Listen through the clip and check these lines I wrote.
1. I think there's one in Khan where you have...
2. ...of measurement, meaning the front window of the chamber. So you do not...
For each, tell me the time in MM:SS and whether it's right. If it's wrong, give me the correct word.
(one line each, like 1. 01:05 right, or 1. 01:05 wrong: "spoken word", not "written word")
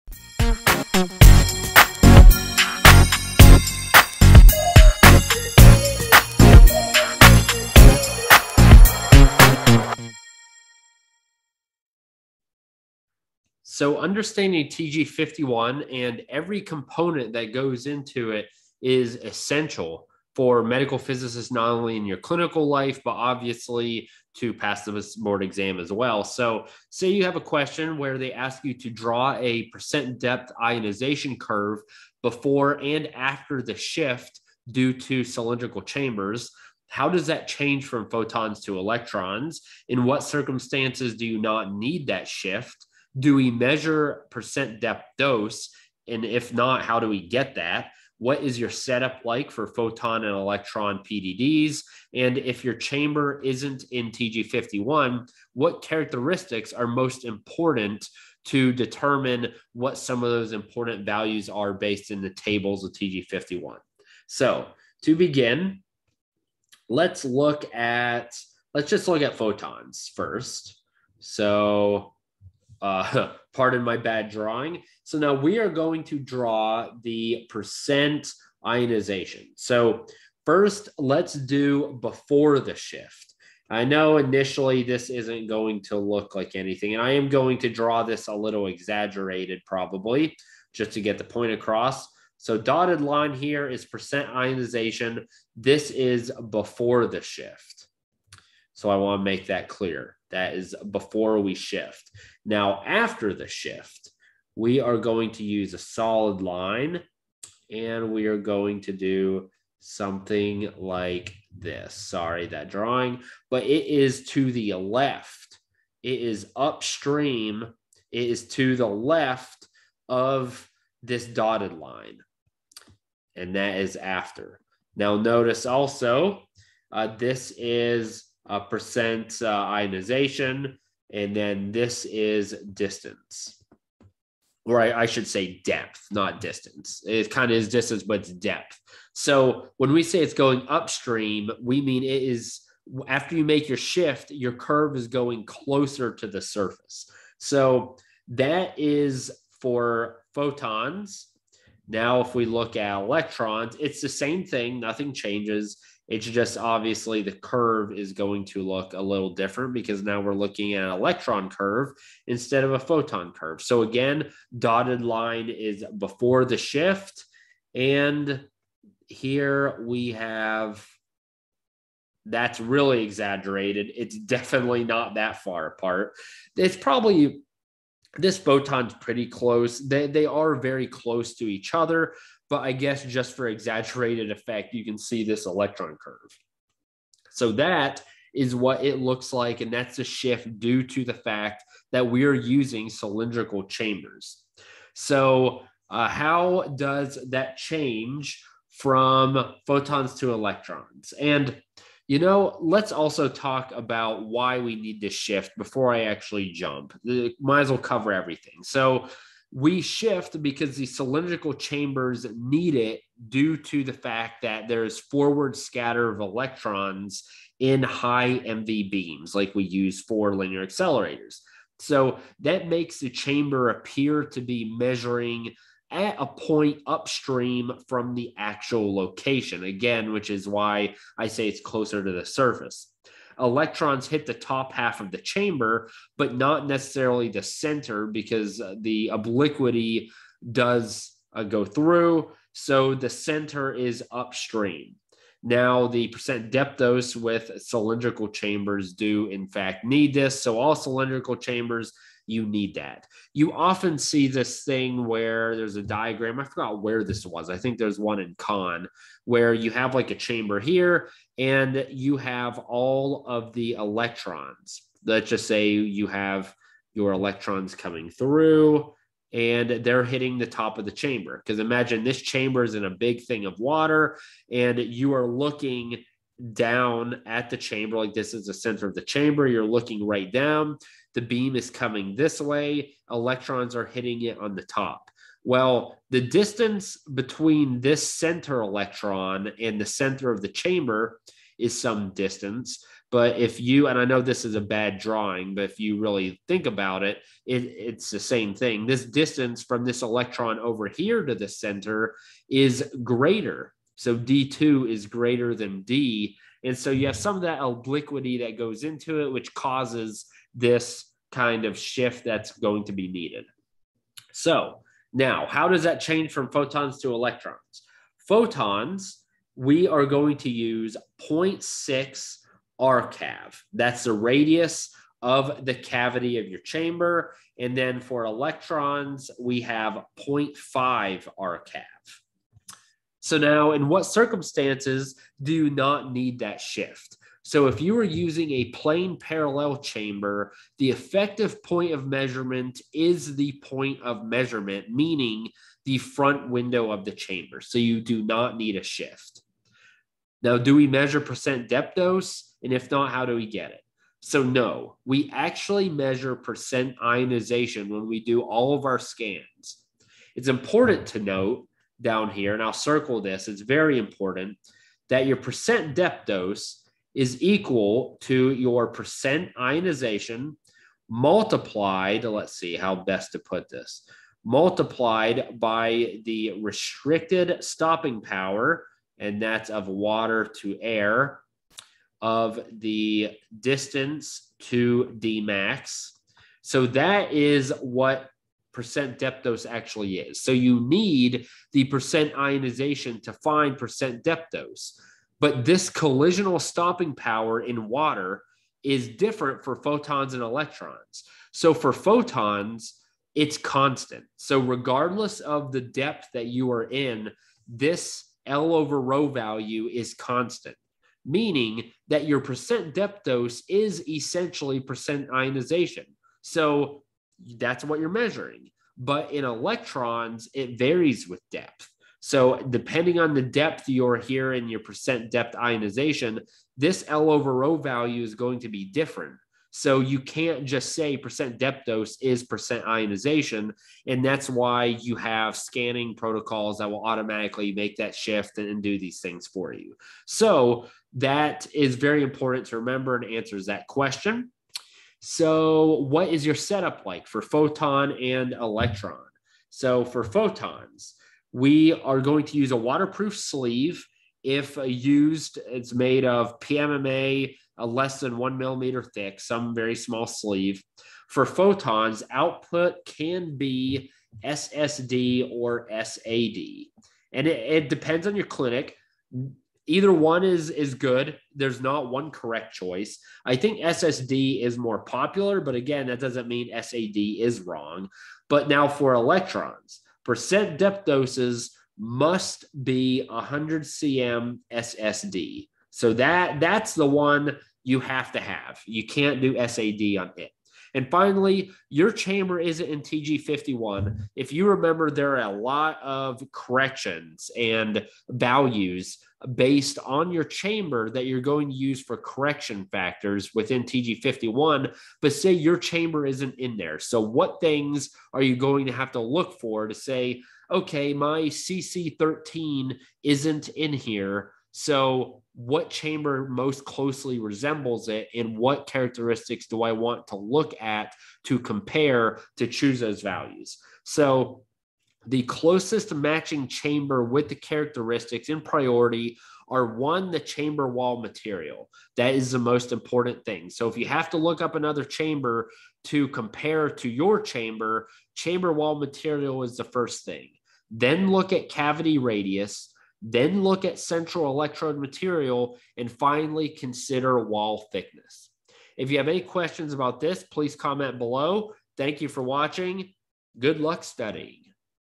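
1. 04:17 right
2. 05:44 right.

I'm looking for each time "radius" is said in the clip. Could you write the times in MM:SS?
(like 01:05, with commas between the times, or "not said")
05:24, 09:02.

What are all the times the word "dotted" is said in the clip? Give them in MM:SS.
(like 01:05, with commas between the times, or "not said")
01:32, 02:01, 02:44.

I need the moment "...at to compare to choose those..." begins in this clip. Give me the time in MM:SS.
08:40.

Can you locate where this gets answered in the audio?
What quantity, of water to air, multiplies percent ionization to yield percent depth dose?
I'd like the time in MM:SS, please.
06:16.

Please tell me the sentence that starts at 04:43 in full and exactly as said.
Electrons are hitting it on the top.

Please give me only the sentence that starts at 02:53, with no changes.
It's definitely not that far apart.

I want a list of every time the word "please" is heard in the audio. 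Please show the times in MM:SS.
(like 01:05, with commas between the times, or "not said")
09:10.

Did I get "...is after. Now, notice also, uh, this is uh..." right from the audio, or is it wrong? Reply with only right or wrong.
right.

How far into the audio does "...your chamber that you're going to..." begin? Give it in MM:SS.
08:20.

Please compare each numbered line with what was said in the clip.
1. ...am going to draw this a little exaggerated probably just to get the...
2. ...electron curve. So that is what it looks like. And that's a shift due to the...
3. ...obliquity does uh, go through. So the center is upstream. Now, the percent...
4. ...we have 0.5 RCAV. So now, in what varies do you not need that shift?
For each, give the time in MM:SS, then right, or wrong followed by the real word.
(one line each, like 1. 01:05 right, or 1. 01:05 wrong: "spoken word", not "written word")
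1. 01:27 right
2. 03:05 right
3. 03:59 right
4. 05:29 wrong: "circumstances", not "varies".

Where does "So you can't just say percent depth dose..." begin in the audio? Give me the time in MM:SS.
07:09.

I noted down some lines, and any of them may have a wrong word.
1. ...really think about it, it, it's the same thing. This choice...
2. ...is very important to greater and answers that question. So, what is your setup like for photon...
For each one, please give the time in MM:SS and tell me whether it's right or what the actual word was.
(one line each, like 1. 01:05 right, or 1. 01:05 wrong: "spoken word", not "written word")
1. 04:55 wrong: "distance", not "choice"
2. 07:21 wrong: "remember", not "greater".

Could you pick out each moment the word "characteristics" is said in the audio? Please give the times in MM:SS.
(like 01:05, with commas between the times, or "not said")
00:55, 08:38, 08:47.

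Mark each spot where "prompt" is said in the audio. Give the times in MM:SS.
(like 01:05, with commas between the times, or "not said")
not said.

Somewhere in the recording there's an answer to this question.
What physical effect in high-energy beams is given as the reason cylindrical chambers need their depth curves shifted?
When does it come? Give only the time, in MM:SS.
03:34.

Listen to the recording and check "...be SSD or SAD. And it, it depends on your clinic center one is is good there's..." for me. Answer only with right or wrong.
wrong.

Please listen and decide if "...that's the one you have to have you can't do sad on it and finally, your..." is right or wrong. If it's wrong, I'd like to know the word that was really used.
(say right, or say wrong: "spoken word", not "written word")
right.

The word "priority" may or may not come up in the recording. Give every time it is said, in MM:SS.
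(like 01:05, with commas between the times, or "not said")
08:48.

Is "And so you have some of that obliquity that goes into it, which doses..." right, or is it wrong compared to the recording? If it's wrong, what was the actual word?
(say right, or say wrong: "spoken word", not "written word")
wrong: "causes", not "doses".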